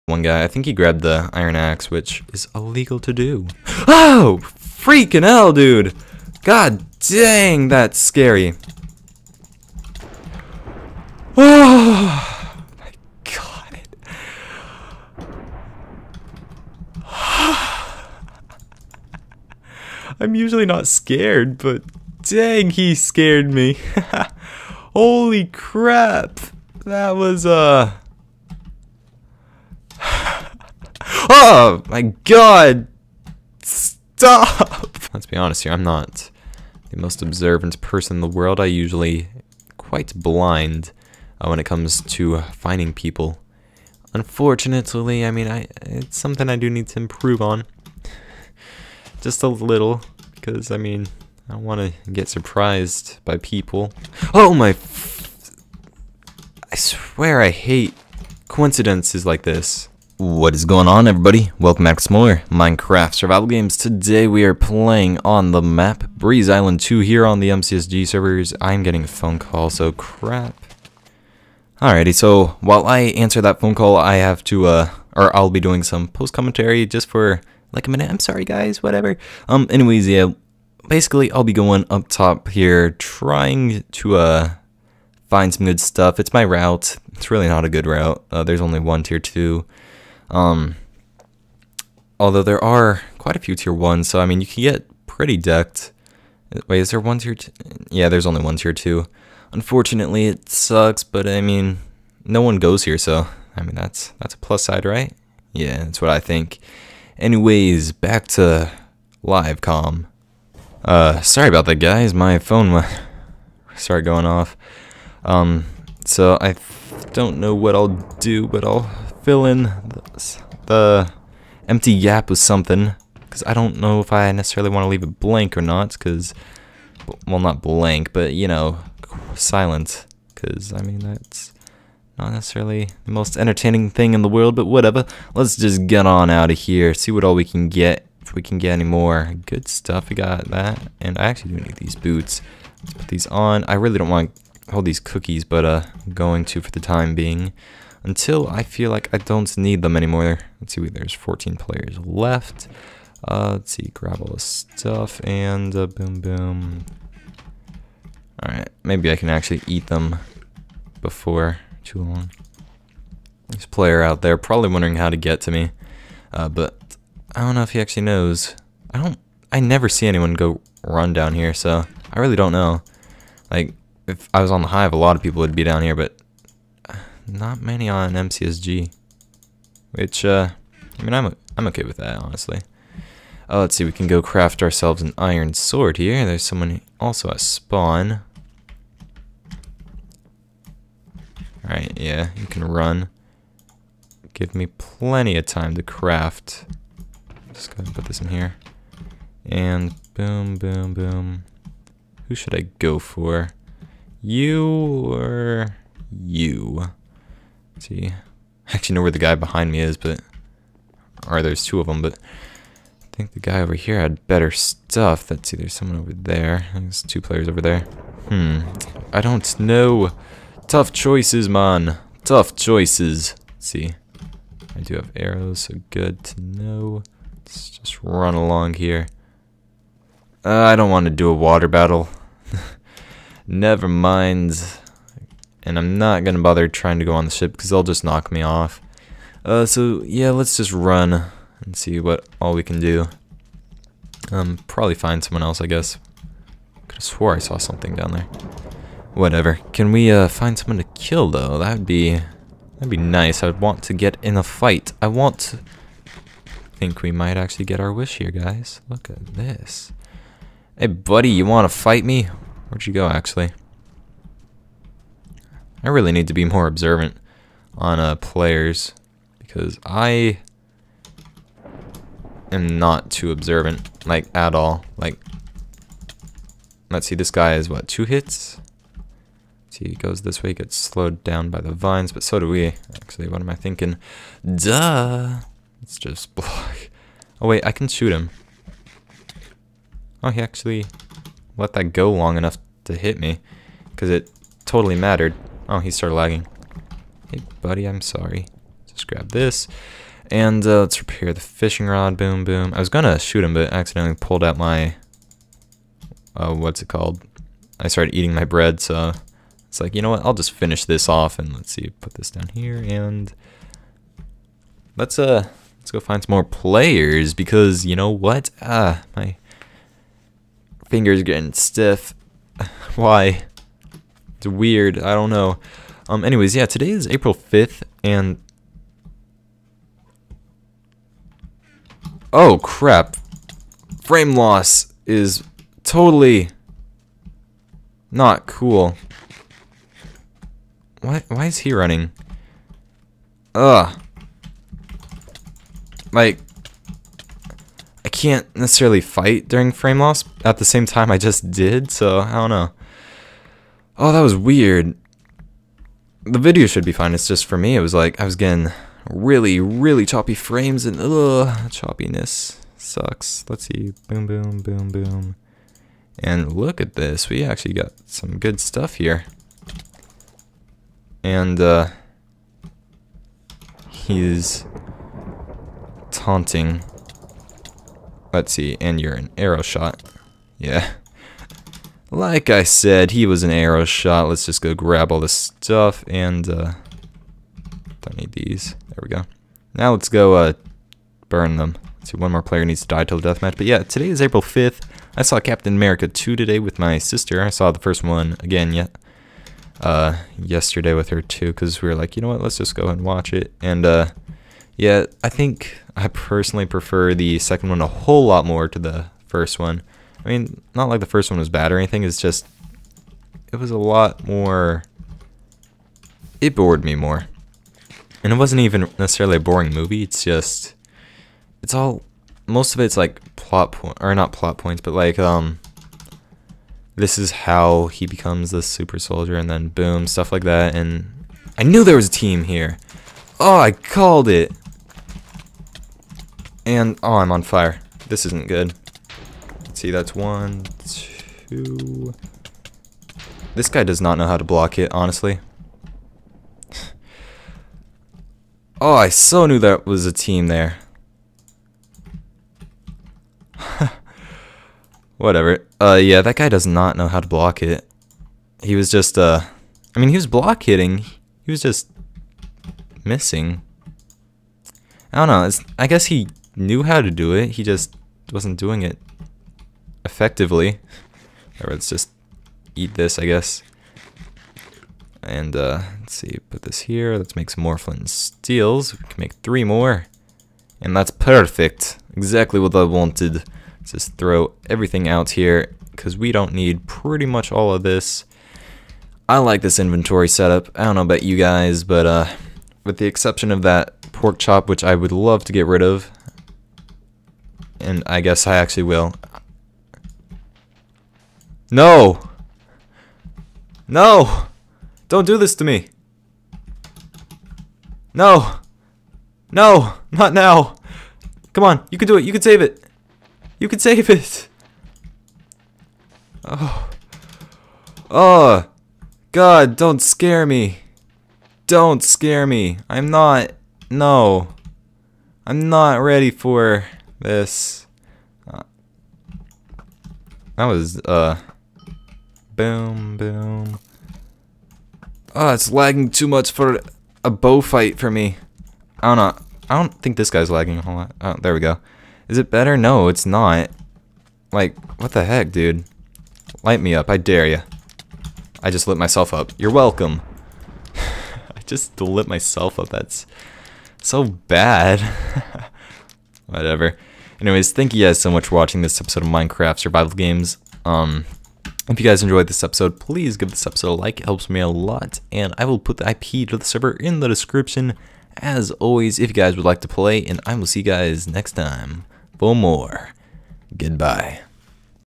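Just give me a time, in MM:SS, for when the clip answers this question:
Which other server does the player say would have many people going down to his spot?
02:54.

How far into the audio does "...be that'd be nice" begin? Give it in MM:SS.
04:11.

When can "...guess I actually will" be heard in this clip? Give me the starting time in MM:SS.
08:18.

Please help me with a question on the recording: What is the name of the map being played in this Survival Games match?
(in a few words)
Breeze Island 2.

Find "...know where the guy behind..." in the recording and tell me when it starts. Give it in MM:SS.
03:28.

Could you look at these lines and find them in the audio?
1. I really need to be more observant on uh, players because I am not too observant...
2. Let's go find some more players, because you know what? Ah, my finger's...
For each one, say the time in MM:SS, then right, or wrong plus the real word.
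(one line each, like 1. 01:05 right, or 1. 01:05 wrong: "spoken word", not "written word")
1. 04:25 right
2. 05:15 right.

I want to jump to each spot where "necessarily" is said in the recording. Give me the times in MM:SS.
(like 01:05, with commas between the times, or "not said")
02:04, 02:12, 05:48, 06:58.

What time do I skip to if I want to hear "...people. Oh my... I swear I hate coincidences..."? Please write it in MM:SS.
00:53.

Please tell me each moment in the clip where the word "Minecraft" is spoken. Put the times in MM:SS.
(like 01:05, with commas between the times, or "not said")
01:02, 09:19.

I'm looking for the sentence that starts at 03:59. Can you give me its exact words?
Uh, so yeah, let's just run and see what all we can do.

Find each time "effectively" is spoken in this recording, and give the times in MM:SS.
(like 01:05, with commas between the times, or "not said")
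07:50.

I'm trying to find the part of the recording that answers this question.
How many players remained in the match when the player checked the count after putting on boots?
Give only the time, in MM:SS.
02:31.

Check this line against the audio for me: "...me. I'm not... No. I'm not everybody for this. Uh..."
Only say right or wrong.
wrong.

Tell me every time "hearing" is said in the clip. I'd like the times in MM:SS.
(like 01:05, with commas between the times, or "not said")
not said.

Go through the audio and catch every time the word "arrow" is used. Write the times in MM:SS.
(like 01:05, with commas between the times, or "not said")
03:45, 06:19, 06:23.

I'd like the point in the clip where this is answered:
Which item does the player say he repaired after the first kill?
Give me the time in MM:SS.
05:01.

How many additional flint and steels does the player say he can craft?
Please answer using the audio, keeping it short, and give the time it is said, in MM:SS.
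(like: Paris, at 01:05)
3, at 07:59.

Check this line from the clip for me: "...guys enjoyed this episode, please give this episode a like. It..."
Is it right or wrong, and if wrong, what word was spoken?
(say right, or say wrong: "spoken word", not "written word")
right.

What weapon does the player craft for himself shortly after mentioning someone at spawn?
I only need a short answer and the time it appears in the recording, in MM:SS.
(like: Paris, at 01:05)
iron sword, at 03:05.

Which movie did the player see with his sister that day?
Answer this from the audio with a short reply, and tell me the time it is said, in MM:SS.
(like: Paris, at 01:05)
Captain America 2, at 06:35.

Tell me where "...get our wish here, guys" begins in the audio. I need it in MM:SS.
04:17.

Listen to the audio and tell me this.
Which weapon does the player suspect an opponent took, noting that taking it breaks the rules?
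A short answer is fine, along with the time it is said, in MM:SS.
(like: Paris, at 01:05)
iron axe, at 00:01.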